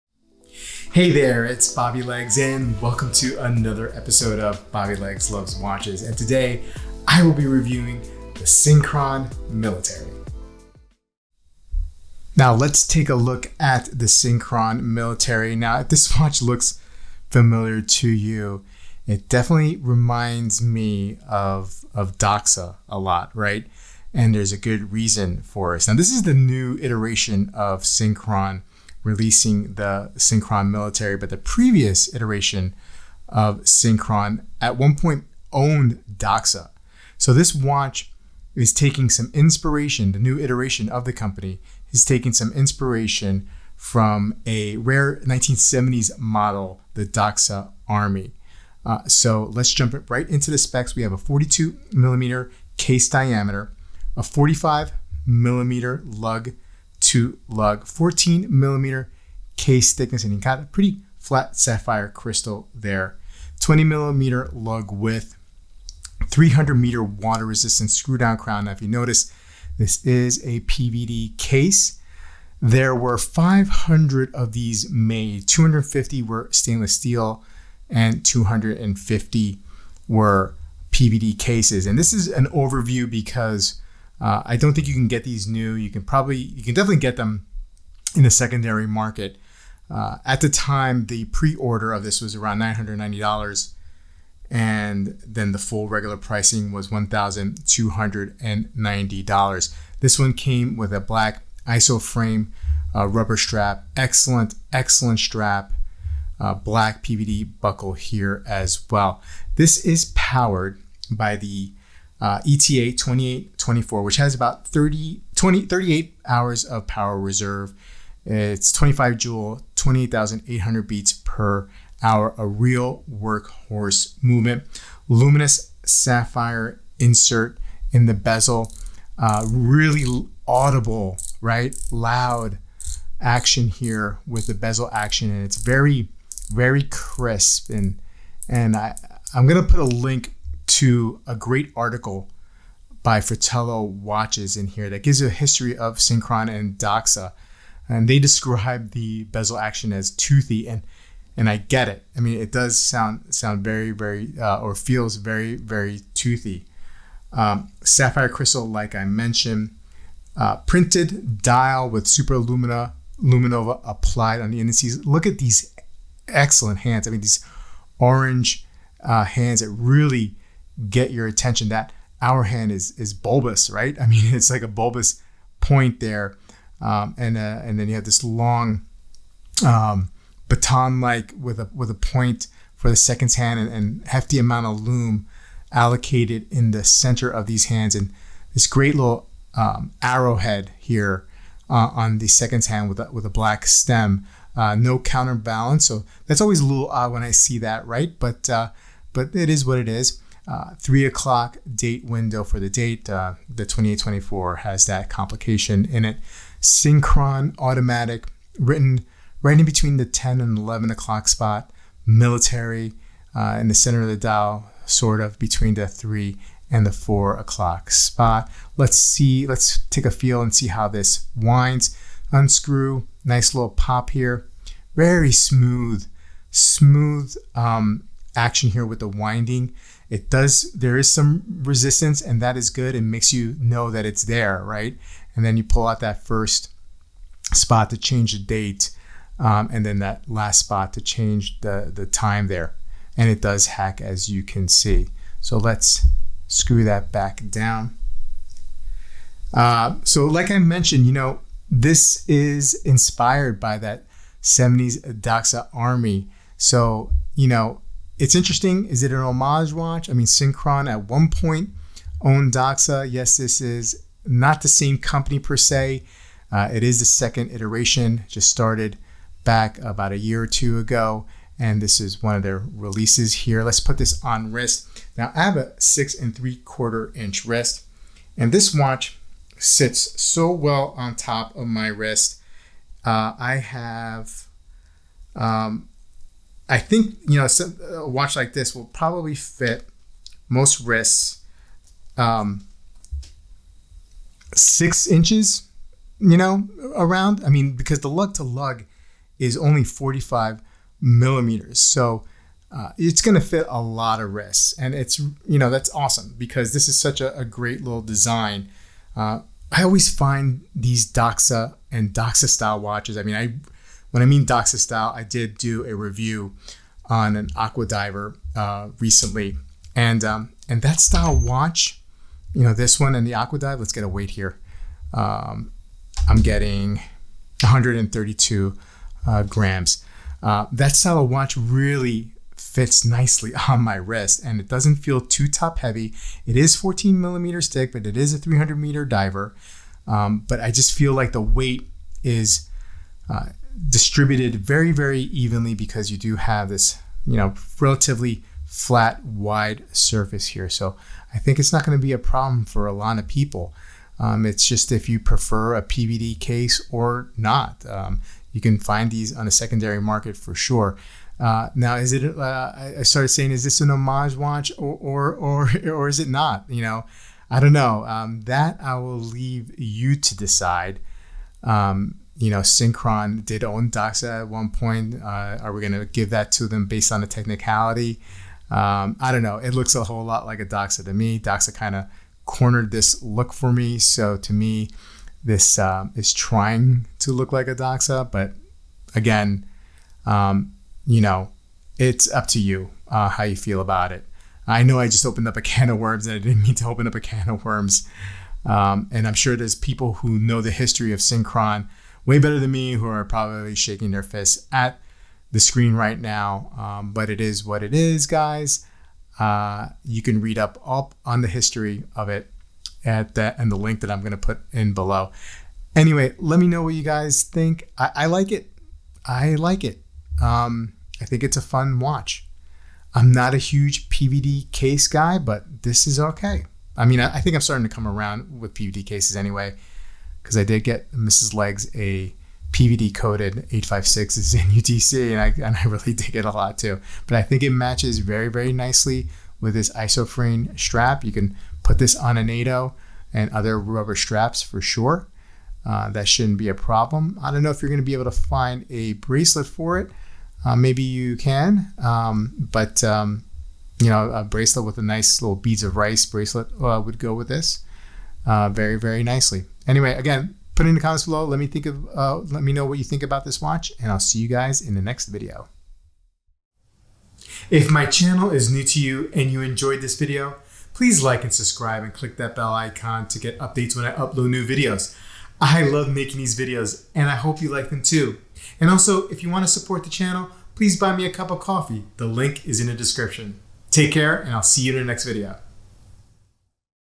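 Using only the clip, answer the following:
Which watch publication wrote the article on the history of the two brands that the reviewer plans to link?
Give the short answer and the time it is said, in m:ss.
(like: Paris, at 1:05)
Fratello Watches, at 2:23.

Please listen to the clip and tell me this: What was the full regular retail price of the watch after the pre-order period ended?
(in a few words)
$1,290.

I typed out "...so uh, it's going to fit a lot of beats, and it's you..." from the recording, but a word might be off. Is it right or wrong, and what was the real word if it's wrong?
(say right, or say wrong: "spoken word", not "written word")
wrong: "wrists", not "beats".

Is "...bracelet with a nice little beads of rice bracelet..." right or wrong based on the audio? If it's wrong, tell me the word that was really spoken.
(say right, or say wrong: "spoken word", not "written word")
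right.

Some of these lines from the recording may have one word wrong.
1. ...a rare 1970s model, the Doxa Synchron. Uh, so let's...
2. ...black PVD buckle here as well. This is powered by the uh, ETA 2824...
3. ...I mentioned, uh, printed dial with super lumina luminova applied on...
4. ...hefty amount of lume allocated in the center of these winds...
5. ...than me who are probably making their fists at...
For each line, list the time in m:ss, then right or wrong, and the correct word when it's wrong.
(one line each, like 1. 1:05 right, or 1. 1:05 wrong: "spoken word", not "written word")
1. 0:44 wrong: "Army", not "Synchron"
2. 1:46 right
3. 2:38 right
4. 3:04 wrong: "hands", not "winds"
5. 6:42 wrong: "shaking", not "making".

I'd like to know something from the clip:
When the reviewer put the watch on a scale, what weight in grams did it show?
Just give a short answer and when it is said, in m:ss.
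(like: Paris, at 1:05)
132 grams, at 5:27.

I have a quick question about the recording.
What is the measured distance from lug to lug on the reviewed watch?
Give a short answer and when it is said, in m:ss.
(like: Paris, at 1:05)
45 millimeters, at 0:54.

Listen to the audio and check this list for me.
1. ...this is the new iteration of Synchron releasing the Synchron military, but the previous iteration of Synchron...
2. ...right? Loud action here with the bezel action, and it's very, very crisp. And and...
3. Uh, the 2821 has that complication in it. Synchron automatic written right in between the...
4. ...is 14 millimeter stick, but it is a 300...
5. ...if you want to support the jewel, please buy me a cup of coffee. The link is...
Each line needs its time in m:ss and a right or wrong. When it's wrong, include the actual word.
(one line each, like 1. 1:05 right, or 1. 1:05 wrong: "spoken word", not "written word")
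1. 0:25 right
2. 2:11 right
3. 3:23 wrong: "2824", not "2821"
4. 5:36 right
5. 7:59 wrong: "channel", not "jewel".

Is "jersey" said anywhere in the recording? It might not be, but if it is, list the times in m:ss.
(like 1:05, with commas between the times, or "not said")
not said.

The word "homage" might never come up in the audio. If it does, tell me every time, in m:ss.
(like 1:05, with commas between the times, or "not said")
4:19, 6:03.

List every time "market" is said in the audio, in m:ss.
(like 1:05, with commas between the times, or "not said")
1:28, 6:00.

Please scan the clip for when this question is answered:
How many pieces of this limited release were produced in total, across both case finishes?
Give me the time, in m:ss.
1:13.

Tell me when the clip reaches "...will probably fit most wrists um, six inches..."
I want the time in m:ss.
4:48.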